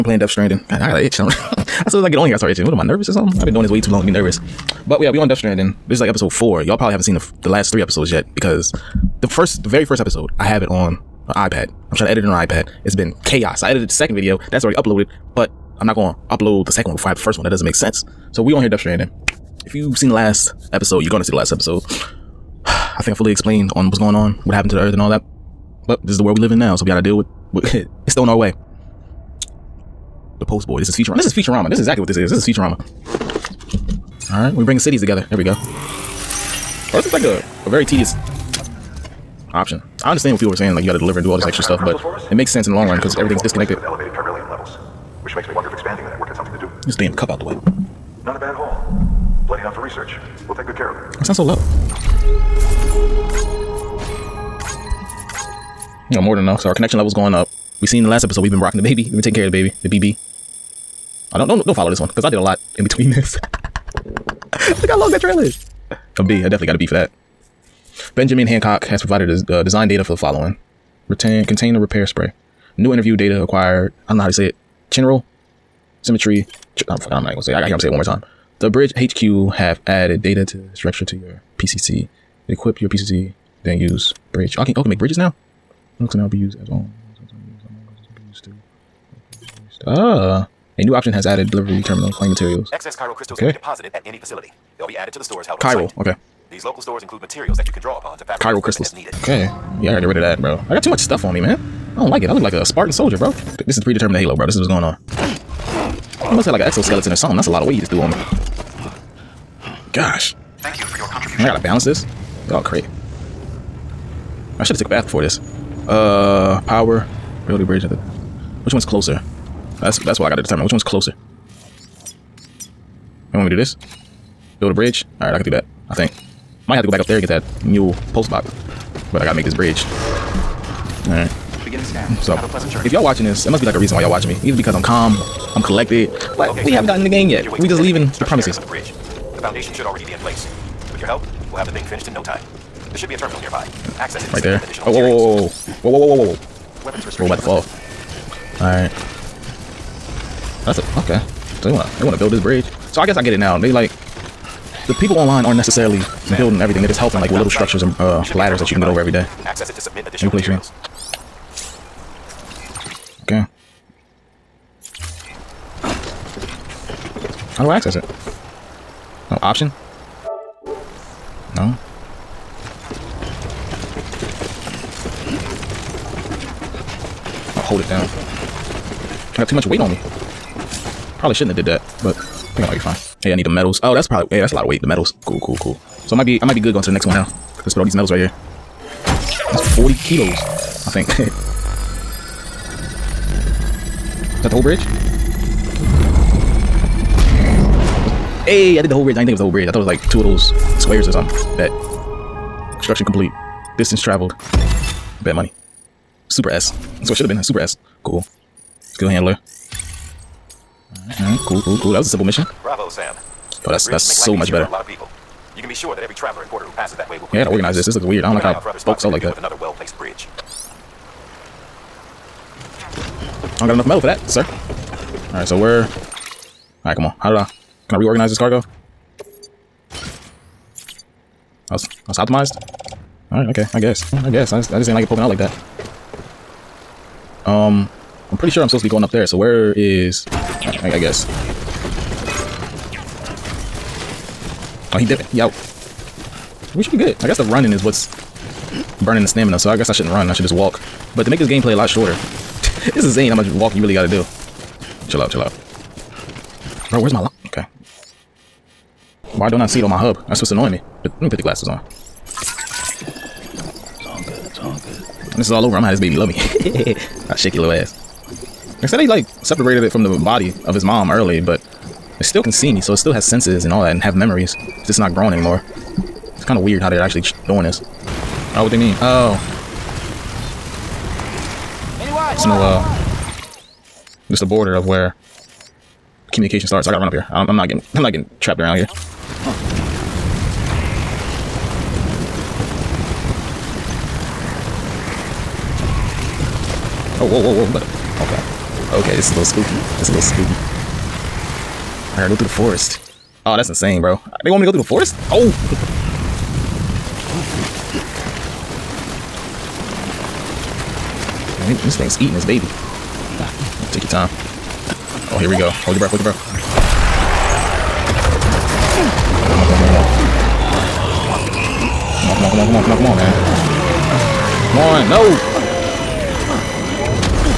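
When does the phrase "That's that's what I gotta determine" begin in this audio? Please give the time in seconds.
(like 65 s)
119 s.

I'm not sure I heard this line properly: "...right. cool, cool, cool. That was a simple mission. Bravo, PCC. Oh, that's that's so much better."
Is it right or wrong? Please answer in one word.
wrong.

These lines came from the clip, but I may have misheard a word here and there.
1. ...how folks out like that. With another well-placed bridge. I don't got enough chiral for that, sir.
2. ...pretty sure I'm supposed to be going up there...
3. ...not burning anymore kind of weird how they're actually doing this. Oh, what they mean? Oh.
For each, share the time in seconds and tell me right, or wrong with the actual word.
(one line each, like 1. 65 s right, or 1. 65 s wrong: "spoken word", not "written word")
1. 218 s wrong: "metal", not "chiral"
2. 238 s right
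3. 274 s wrong: "growing", not "burning".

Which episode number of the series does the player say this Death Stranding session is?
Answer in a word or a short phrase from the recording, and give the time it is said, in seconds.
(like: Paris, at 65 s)
4, at 6 s.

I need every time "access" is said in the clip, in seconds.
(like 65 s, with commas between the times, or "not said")
143 s, 159 s, 167 s.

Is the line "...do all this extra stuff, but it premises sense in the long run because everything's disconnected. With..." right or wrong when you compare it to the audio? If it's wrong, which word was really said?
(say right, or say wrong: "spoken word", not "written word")
wrong: "makes", not "premises".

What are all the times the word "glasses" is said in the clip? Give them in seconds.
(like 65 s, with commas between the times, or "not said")
261 s.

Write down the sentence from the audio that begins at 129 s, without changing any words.
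But I gotta make this bridge.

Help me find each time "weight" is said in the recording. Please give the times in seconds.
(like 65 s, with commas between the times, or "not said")
107 s, 179 s, 184 s.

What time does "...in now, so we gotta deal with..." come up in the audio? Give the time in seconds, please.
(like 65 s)
26 s.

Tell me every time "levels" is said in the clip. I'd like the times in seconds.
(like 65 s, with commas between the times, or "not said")
44 s, 56 s.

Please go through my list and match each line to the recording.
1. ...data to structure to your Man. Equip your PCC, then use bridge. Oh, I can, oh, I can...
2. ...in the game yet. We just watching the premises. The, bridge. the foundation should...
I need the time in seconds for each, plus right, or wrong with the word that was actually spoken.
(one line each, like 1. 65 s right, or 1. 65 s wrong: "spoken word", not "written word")
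1. 80 s wrong: "PCC", not "Man"
2. 137 s wrong: "leaving", not "watching".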